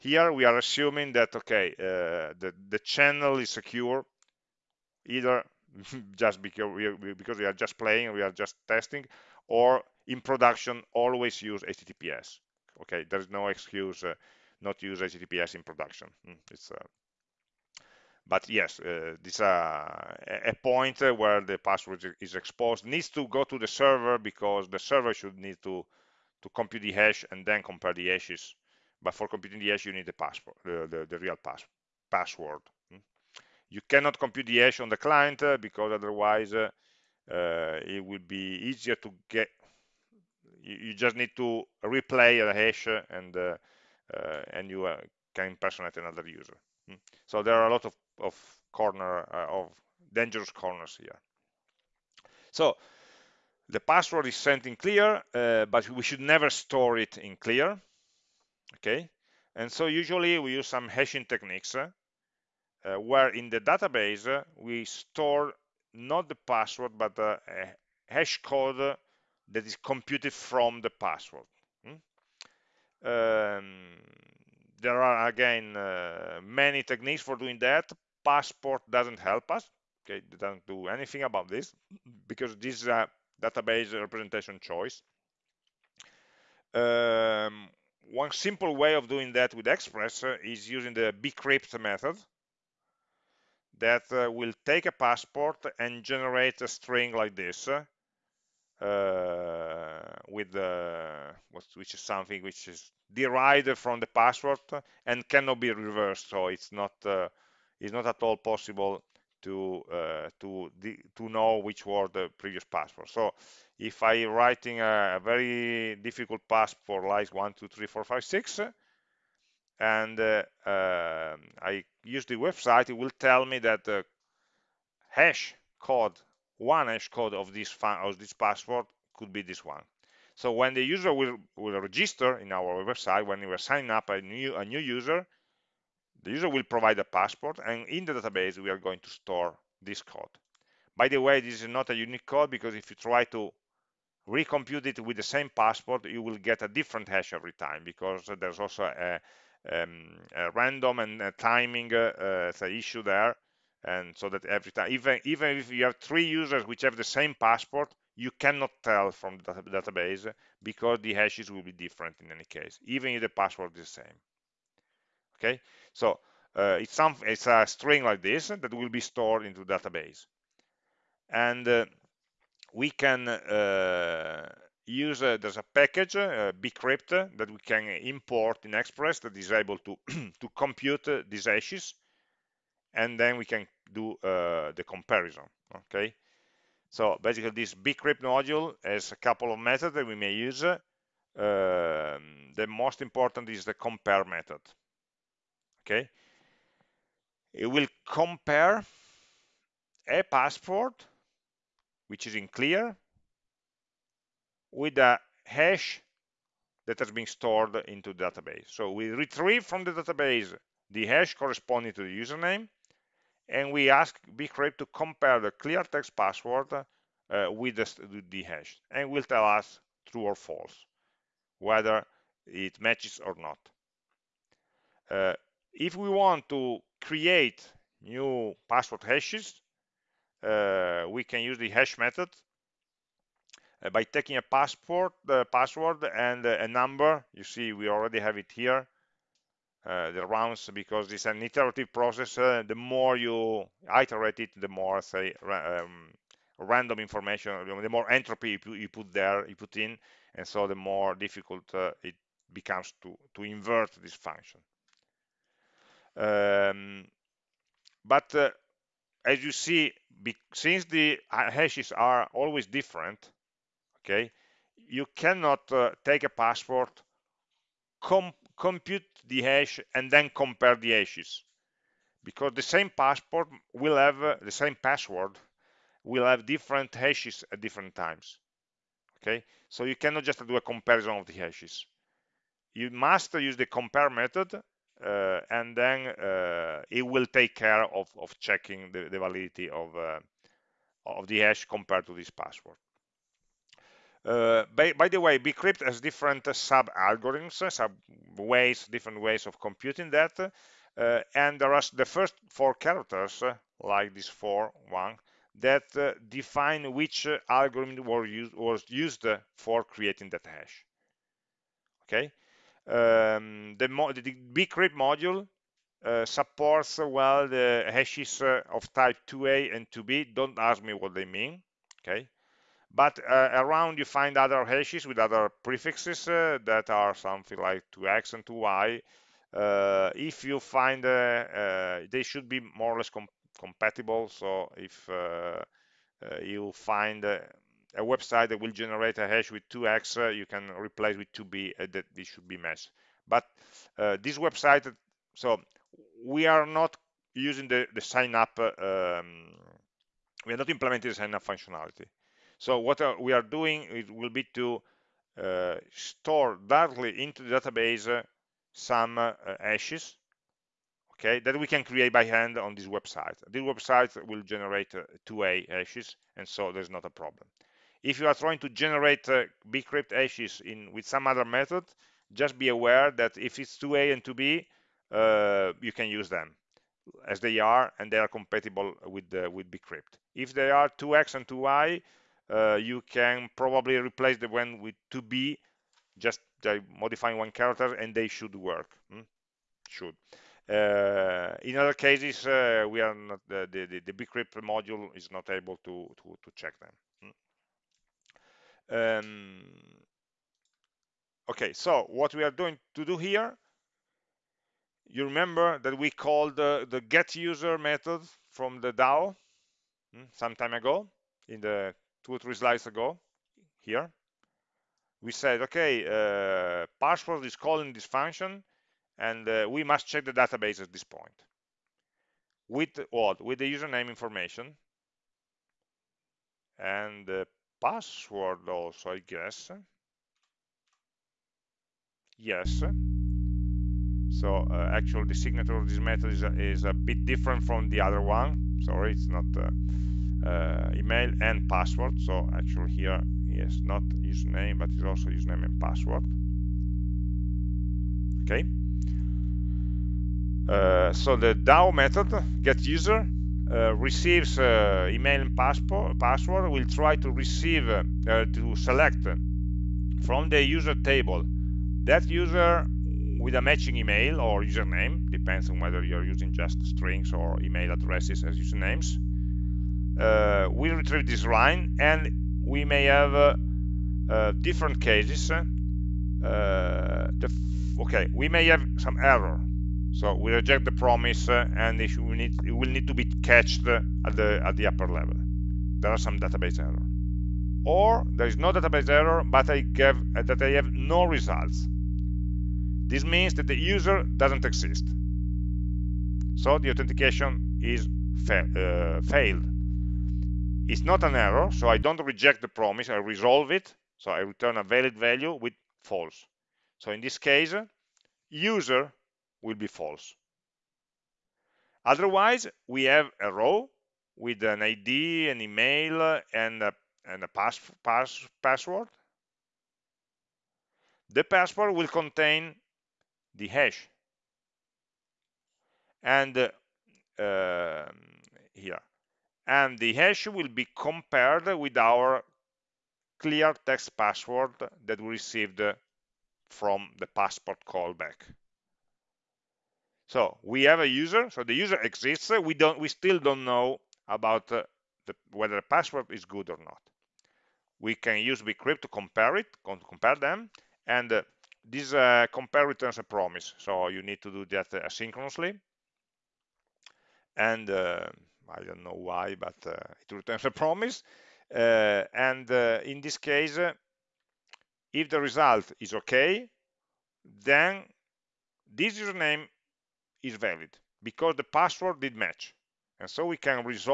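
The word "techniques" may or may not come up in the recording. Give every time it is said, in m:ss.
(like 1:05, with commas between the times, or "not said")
1:01, 1:16.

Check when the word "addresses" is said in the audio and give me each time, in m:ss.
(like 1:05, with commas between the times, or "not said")
7:47.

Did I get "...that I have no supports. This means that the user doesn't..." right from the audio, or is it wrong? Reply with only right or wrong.
wrong.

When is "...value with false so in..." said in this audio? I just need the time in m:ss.
8:25.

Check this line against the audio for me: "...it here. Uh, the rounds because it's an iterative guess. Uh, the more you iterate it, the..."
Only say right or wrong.
wrong.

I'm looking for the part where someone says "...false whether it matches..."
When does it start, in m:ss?
3:40.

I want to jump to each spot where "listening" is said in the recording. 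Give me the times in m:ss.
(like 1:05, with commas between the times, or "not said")
not said.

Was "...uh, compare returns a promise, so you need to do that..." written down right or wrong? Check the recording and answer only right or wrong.
right.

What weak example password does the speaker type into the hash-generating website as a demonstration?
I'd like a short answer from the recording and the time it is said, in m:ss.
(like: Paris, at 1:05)
123456, at 1:57.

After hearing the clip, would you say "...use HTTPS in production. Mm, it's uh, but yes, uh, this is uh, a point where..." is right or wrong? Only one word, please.
right.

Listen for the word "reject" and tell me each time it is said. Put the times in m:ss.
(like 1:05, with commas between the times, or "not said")
8:00, 8:22.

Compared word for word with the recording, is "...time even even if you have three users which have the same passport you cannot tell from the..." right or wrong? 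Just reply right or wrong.
right.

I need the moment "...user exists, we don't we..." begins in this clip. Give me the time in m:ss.
9:01.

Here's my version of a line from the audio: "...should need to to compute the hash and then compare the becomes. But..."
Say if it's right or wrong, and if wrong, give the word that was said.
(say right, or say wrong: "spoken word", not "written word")
wrong: "hashes", not "becomes".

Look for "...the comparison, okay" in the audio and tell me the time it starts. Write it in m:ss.
3:04.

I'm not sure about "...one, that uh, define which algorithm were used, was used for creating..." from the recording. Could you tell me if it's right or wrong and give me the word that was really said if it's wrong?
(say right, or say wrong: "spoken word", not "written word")
right.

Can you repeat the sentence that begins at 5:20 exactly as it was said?
Don't ask me what they mean.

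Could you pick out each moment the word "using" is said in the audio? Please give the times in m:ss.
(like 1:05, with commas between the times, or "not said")
1:30, 5:47, 7:46.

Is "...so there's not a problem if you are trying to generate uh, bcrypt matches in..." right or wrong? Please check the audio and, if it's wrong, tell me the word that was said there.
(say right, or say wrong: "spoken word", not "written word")
wrong: "hashes", not "matches".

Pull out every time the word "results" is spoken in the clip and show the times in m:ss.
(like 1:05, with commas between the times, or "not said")
8:11, 9:25.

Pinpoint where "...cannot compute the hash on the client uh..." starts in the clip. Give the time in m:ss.
0:33.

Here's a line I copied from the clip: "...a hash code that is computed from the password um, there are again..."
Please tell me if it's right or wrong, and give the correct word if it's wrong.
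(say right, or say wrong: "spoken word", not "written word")
right.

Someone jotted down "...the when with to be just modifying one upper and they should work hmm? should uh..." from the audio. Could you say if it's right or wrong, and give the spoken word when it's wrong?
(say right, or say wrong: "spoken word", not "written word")
wrong: "character", not "upper".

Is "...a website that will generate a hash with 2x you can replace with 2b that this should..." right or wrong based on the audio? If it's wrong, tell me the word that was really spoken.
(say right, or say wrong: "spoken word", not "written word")
right.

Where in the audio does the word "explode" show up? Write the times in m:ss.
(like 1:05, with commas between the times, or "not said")
not said.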